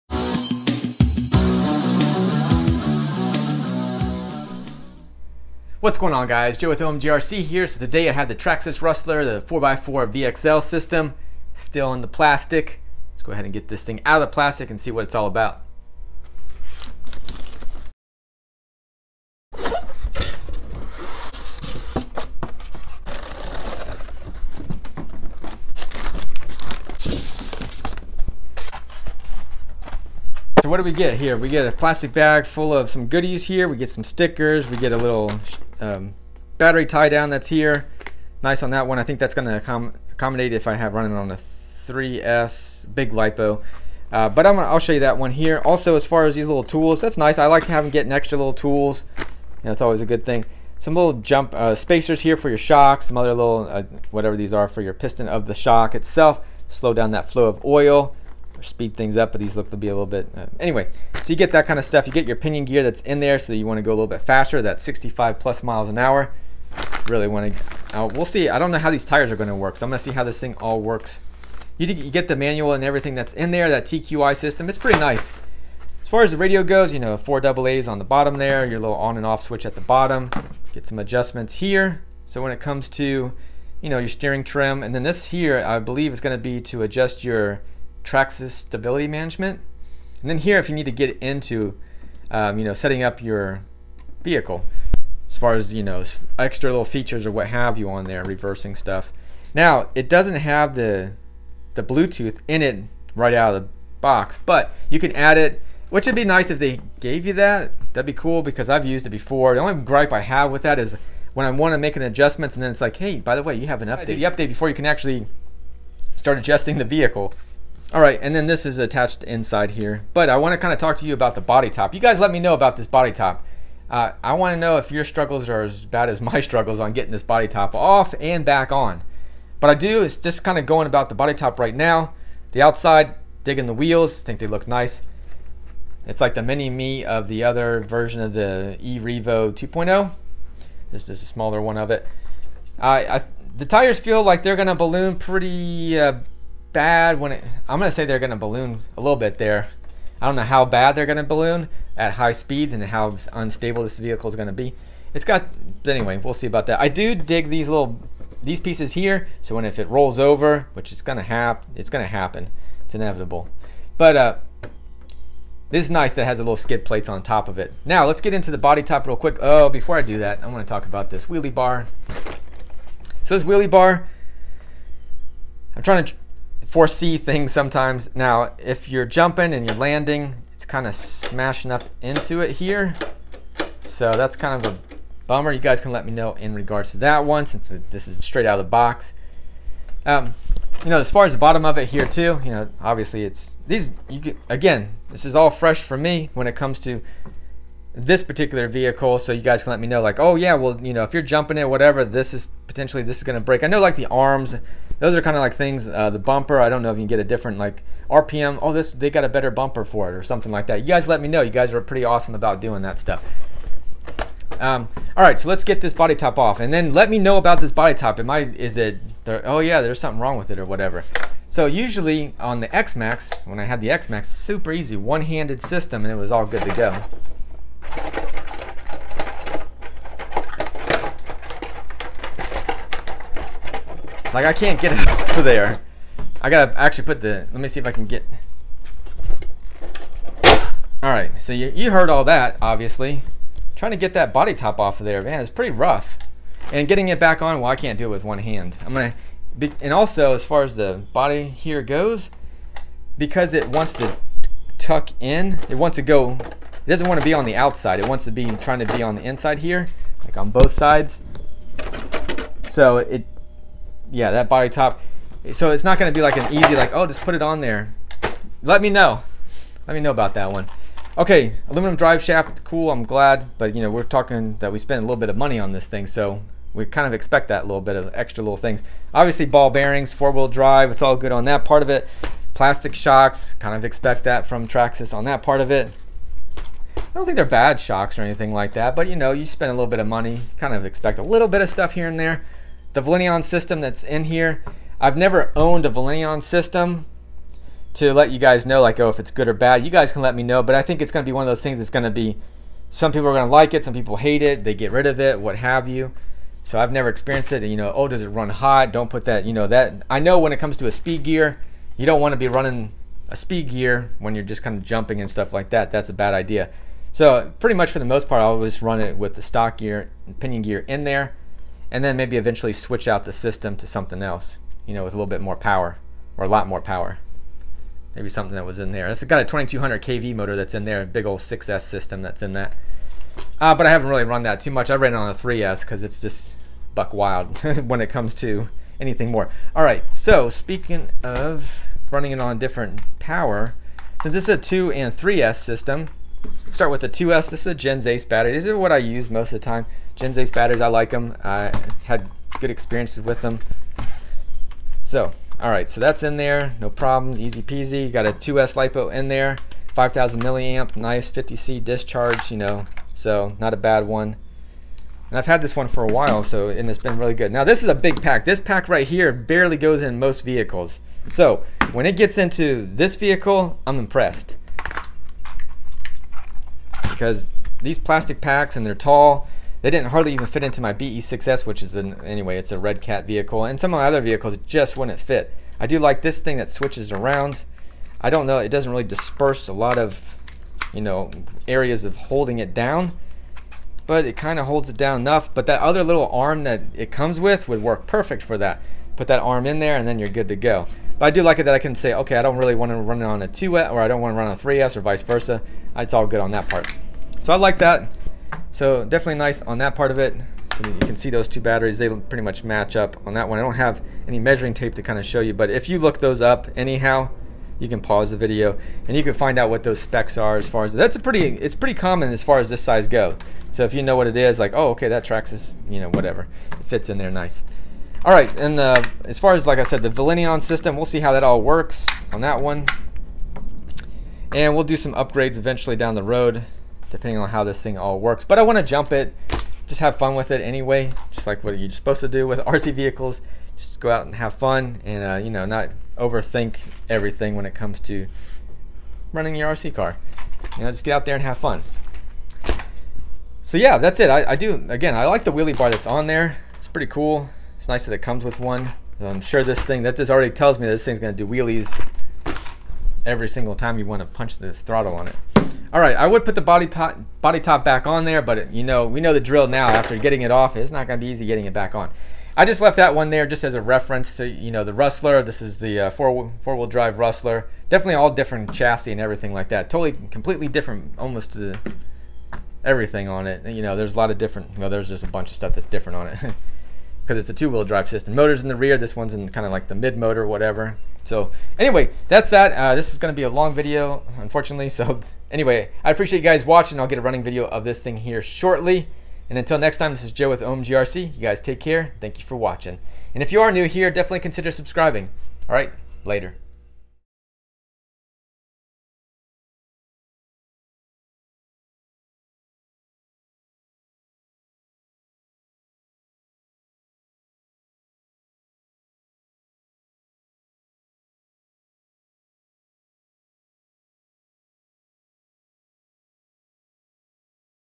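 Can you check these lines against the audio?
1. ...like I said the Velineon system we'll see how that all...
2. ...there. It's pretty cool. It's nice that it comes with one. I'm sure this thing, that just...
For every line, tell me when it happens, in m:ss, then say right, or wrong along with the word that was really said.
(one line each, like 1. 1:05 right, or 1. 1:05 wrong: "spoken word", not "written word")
1. 7:09 right
2. 7:36 right.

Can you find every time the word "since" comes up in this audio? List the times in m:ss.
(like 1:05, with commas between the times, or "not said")
3:07, 5:44.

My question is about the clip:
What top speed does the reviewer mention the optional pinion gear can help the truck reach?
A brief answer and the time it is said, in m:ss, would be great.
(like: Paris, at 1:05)
65+ mph, at 1:04.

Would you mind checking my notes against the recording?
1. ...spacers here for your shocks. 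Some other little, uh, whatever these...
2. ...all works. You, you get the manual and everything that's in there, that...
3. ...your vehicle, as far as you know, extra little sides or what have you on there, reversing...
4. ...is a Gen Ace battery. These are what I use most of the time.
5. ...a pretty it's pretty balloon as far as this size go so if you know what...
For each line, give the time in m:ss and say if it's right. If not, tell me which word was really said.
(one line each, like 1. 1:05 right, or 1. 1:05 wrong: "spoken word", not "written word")
1. 0:51 right
2. 1:10 right
3. 1:33 wrong: "features", not "sides"
4. 5:47 right
5. 7:01 wrong: "common", not "balloon".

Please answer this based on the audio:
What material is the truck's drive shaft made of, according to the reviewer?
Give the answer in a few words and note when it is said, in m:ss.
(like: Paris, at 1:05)
Aluminum, at 4:31.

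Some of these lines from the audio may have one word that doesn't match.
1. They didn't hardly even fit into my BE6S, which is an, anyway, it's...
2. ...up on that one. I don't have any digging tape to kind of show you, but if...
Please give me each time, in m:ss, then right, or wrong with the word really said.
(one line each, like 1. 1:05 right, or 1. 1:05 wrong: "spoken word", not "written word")
1. 6:19 right
2. 6:52 wrong: "measuring", not "digging".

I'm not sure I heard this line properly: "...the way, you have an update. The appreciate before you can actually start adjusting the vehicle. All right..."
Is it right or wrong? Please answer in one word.
wrong.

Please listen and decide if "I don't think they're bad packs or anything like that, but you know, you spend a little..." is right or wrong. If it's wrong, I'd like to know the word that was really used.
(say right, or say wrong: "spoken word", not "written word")
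wrong: "shocks", not "packs".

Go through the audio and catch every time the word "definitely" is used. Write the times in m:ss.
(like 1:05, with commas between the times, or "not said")
6:49, 7:57, 8:24.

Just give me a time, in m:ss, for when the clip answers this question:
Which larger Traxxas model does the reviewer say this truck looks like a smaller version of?
2:18.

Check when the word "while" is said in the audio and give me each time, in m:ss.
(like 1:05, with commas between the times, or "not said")
6:06.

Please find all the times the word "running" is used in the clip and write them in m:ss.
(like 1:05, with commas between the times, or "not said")
0:40, 5:12, 5:42, 7:29, 8:17.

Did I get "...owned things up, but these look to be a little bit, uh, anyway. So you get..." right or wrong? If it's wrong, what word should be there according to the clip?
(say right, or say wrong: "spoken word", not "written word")
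wrong: "speed", not "owned".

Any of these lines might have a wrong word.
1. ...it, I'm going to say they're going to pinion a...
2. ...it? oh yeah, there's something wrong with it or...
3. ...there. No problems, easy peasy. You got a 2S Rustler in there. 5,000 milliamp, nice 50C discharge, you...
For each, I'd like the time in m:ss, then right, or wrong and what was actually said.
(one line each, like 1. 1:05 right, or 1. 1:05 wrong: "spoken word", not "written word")
1. 2:27 wrong: "balloon", not "pinion"
2. 3:38 right
3. 5:56 wrong: "LiPo", not "Rustler".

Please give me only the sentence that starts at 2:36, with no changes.
I do dig these little, these pieces here.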